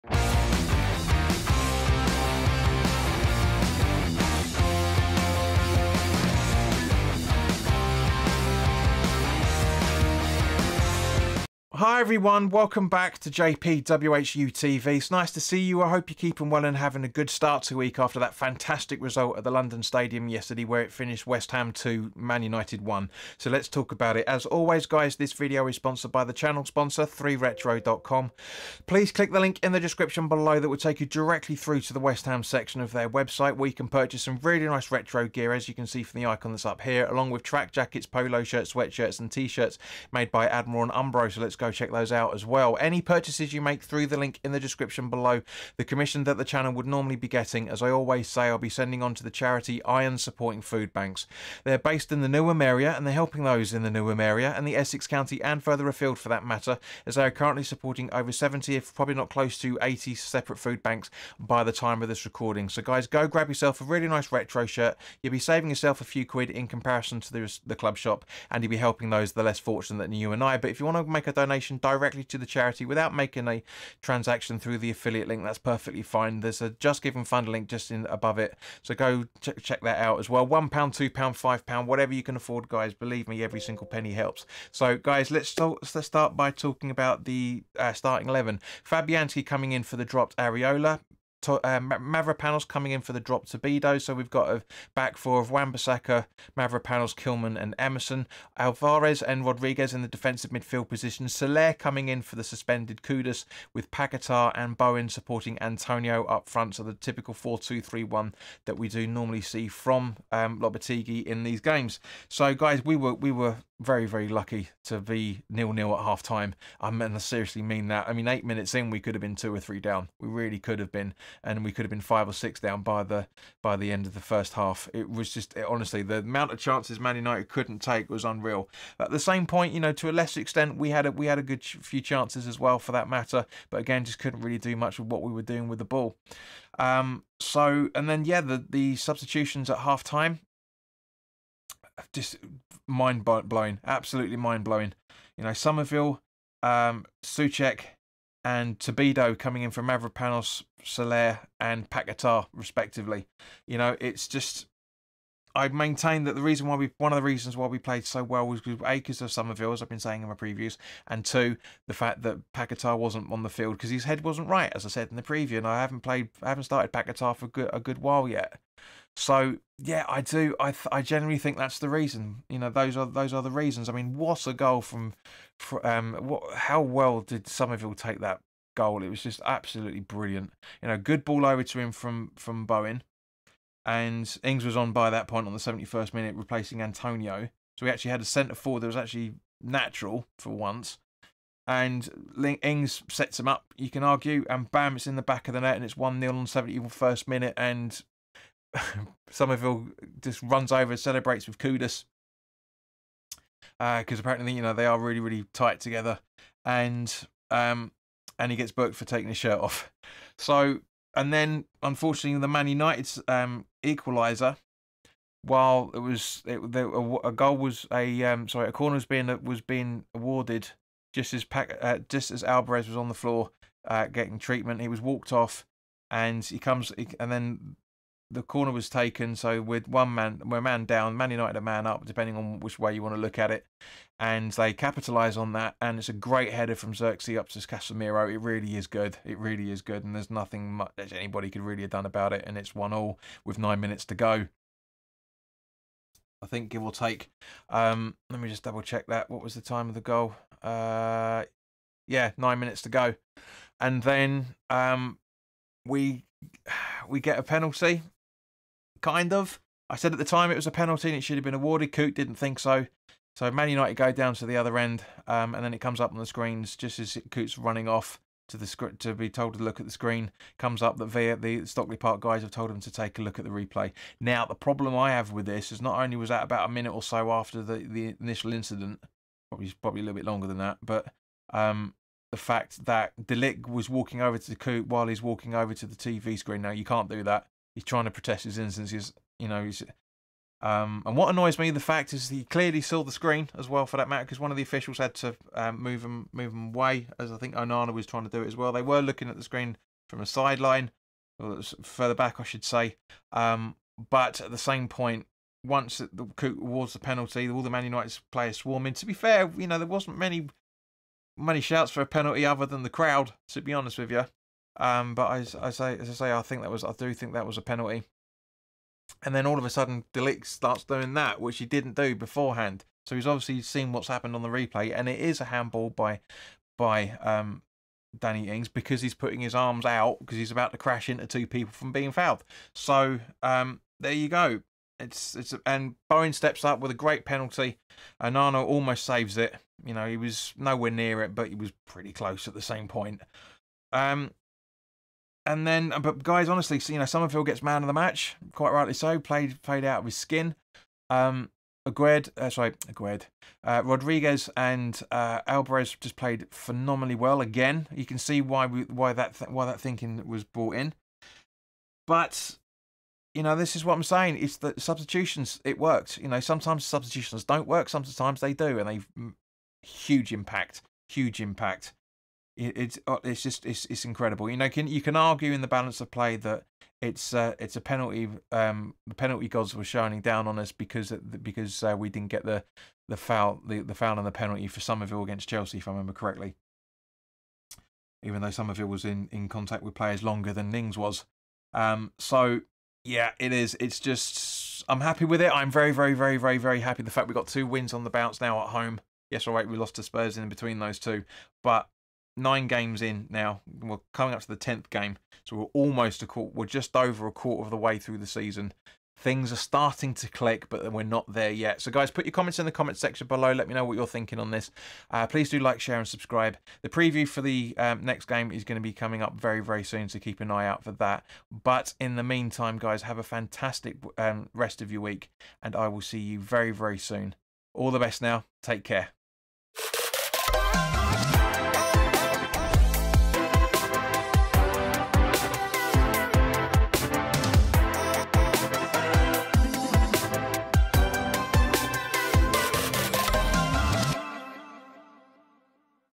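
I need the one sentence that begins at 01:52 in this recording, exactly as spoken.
So, guys, we were, we were very, very lucky to be nil nil at half time.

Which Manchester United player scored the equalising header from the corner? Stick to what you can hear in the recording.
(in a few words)
Casemiro.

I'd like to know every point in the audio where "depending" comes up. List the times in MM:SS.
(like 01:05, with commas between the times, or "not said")
03:52.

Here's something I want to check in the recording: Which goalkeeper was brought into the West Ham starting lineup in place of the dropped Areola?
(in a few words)
Fabianski.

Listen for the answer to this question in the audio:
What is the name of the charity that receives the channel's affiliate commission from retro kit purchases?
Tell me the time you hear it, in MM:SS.
00:49.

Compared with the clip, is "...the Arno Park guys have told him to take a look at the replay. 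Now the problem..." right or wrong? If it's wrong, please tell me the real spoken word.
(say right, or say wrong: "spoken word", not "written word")
wrong: "Stockley", not "Arno".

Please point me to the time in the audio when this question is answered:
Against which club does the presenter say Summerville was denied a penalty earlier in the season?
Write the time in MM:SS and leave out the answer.
06:25.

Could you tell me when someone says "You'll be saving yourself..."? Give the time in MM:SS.
01:05.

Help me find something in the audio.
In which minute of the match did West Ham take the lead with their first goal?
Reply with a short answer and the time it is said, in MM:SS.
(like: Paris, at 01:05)
71, at 03:16.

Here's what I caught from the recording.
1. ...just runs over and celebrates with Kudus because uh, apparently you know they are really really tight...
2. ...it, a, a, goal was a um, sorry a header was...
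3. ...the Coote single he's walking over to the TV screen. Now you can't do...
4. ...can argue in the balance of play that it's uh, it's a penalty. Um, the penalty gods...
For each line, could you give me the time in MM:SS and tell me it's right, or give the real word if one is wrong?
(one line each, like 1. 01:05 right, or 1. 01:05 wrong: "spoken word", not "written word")
1. 03:20 right
2. 03:36 wrong: "corner", not "header"
3. 04:44 wrong: "while", not "single"
4. 06:15 right.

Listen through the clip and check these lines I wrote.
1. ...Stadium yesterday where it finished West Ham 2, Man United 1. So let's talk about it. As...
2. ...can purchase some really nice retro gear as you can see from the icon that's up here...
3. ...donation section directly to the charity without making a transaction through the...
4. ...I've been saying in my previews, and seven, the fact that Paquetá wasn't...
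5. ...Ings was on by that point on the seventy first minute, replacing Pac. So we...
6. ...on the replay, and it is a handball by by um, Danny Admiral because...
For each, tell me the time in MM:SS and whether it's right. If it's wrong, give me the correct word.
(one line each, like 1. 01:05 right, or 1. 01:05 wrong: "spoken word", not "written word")
1. 00:19 right
2. 00:33 right
3. 01:11 wrong: "donation", not "section"
4. 02:39 wrong: "two", not "seven"
5. 03:04 wrong: "Antonio", not "Pac"
6. 05:24 wrong: "Ings", not "Admiral".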